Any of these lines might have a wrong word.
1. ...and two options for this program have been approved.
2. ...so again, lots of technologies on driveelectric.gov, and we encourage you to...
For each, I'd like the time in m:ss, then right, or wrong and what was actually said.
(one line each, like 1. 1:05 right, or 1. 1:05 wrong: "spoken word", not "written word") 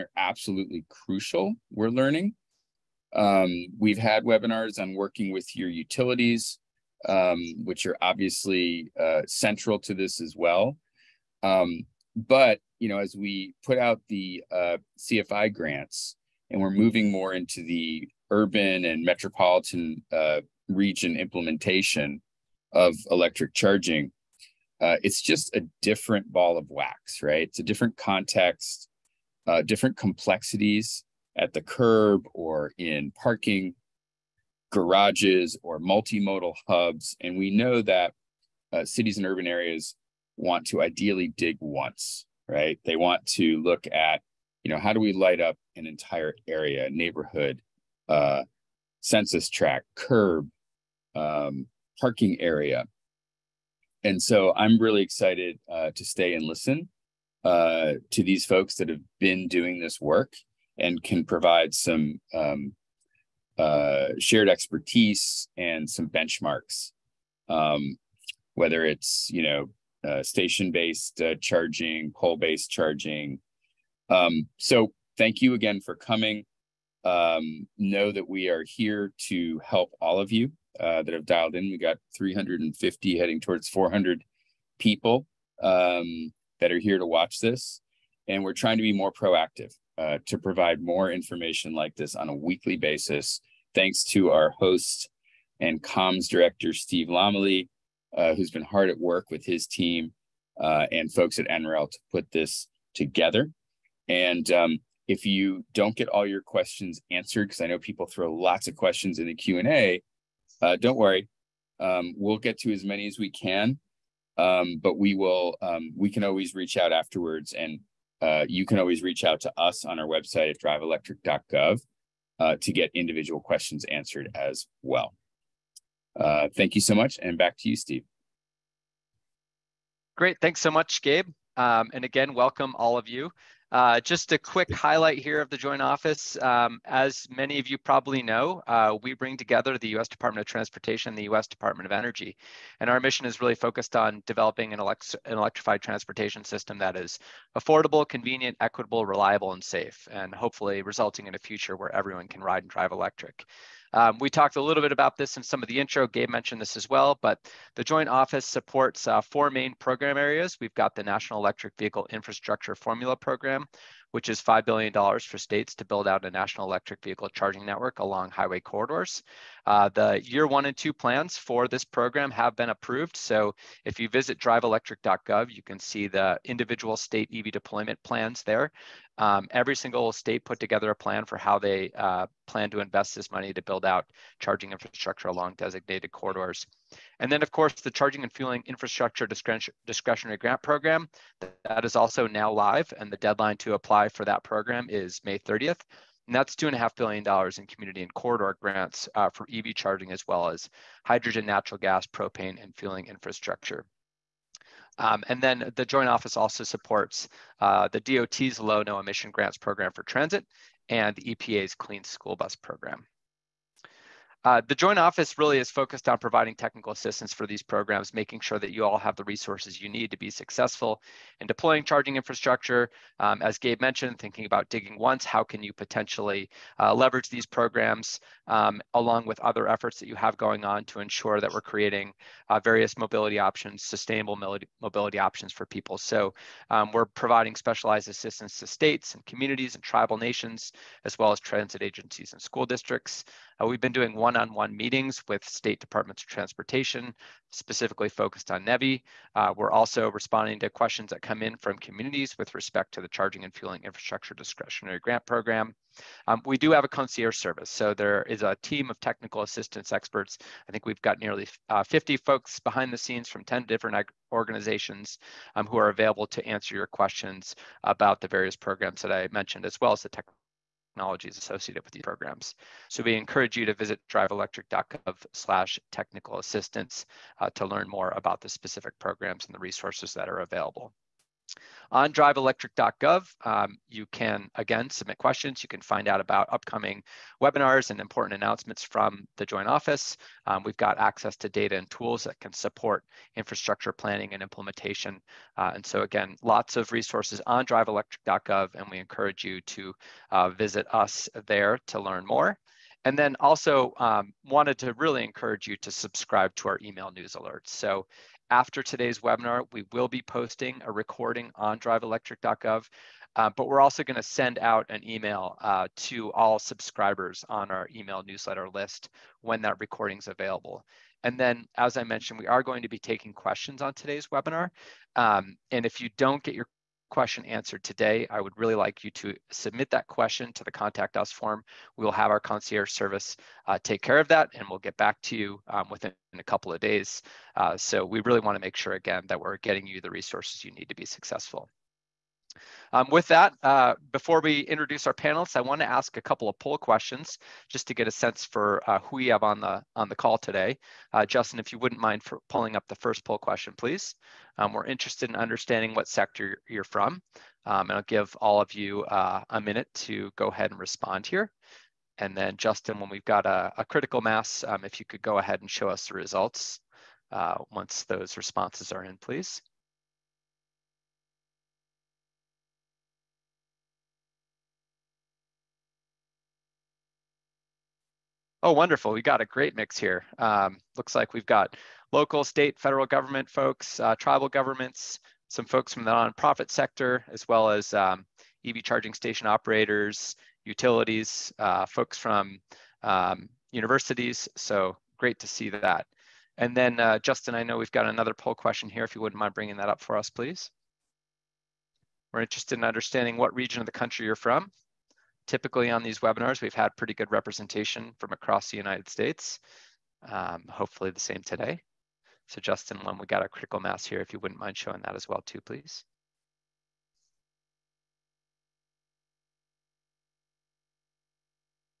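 1. 2:50 wrong: "plans", not "options"
2. 4:55 wrong: "resources", not "technologies".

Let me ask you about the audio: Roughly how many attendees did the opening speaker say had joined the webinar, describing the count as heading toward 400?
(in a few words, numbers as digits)
350.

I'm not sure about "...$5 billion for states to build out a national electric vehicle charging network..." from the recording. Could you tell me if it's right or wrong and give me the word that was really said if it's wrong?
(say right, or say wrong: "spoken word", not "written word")
right.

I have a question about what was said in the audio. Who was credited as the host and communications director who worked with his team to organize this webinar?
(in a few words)
Steve Lommele.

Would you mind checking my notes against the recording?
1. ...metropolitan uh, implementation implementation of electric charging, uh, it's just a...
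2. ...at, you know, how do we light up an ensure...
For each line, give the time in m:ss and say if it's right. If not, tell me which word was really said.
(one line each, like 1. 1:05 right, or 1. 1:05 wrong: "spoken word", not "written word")
1. 0:19 wrong: "region", not "implementation"
2. 0:43 wrong: "entire", not "ensure".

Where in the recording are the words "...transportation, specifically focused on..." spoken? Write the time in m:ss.
4:06.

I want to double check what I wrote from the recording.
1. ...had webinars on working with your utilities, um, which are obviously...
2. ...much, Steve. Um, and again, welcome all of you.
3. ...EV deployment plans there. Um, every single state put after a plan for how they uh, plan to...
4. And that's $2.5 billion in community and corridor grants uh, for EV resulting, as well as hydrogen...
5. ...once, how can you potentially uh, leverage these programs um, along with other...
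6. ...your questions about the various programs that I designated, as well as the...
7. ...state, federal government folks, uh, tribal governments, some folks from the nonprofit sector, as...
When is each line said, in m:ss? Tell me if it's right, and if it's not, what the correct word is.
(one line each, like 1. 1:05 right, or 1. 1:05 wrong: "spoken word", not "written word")
1. 0:03 right
2. 2:10 wrong: "Gabe", not "Steve"
3. 2:57 wrong: "together", not "after"
4. 3:16 wrong: "charging", not "resulting"
5. 3:44 right
6. 4:26 wrong: "mentioned", not "designated"
7. 6:22 right.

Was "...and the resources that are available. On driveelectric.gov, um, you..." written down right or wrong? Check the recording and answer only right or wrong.
right.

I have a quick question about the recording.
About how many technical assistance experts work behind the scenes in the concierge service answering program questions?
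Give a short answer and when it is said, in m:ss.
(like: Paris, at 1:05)
50, at 4:21.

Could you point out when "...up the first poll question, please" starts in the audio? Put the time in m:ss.
5:52.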